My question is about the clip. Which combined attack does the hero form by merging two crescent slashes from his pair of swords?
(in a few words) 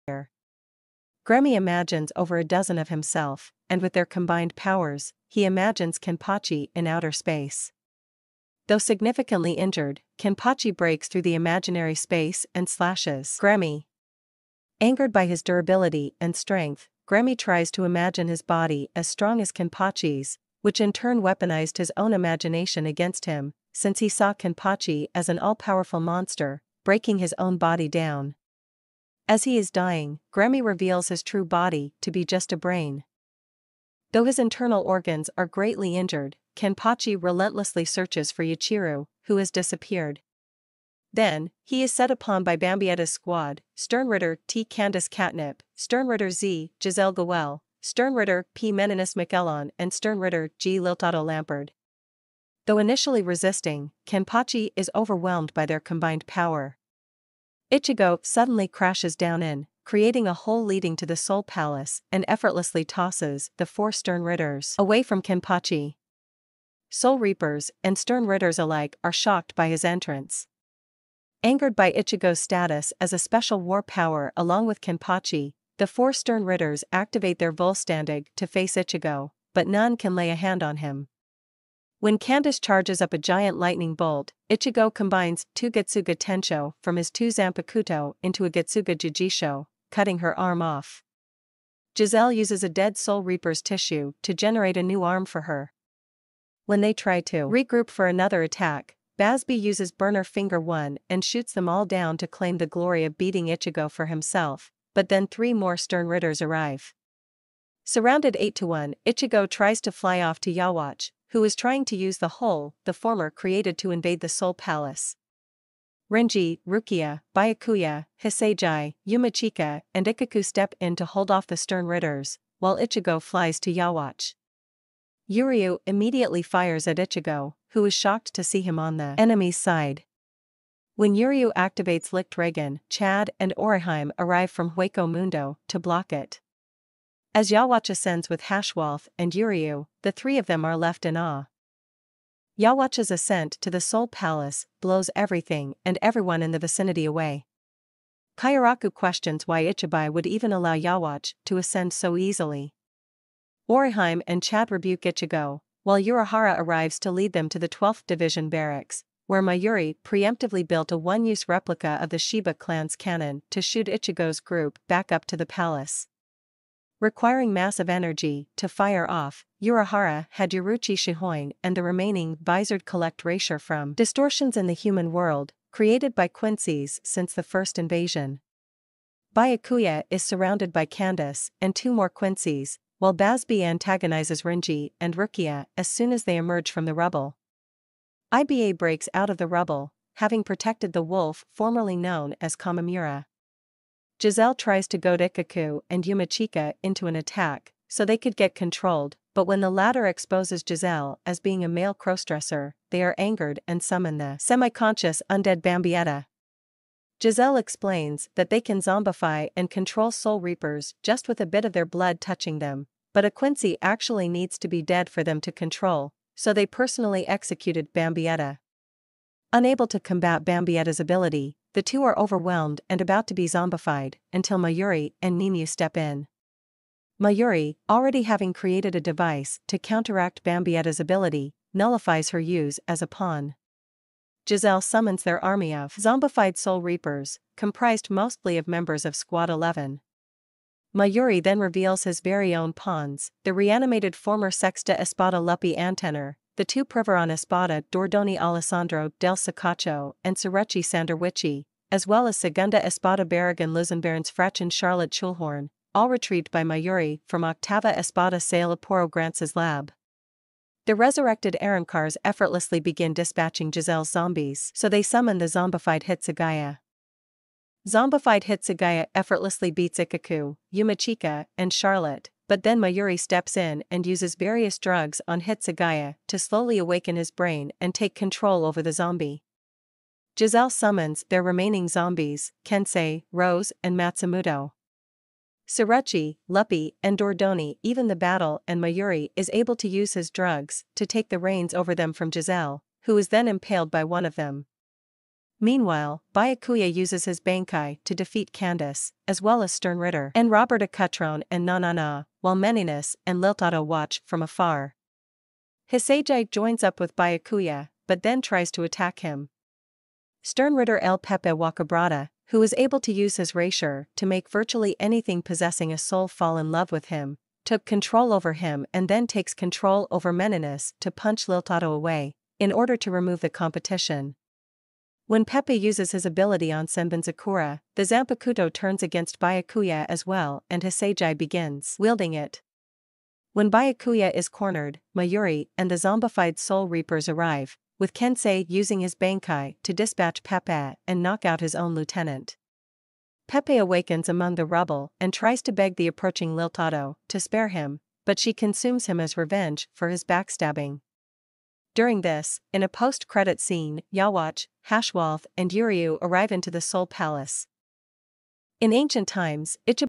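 Getsuga Jujisho.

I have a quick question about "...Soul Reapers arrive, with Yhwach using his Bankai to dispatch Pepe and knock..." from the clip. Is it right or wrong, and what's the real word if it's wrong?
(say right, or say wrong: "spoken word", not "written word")
wrong: "Kensei", not "Yhwach".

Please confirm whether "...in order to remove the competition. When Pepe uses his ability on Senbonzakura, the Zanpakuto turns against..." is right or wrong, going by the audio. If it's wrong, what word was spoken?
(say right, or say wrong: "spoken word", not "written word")
right.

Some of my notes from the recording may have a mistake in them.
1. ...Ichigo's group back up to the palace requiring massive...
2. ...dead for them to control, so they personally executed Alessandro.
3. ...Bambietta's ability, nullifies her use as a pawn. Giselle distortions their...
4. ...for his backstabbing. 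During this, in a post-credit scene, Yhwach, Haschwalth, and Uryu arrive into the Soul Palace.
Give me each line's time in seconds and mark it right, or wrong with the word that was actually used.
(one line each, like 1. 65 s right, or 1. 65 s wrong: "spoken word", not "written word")
1. 163 s right
2. 214 s wrong: "Bambietta", not "Alessandro"
3. 230 s wrong: "summons", not "distortions"
4. 349 s right.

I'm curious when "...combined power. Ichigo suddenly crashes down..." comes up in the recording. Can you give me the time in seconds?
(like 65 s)
55 s.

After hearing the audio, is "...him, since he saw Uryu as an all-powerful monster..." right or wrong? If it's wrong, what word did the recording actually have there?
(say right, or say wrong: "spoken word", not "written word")
wrong: "Kenpachi", not "Uryu".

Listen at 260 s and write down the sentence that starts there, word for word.
The resurrected Arrancars effortlessly begin dispatching Giselle's zombies, so they summon the zombified Hitsugaya.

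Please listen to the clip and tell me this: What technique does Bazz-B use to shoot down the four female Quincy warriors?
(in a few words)
Burner Finger 1.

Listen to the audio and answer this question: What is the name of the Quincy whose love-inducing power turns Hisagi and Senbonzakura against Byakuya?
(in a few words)
El Pepe Waccabrada.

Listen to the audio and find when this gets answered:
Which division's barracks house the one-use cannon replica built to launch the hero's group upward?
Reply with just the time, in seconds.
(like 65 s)
157 s.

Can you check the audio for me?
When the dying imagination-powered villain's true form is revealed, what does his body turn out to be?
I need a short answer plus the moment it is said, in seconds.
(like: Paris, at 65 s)
a brain, at 32 s.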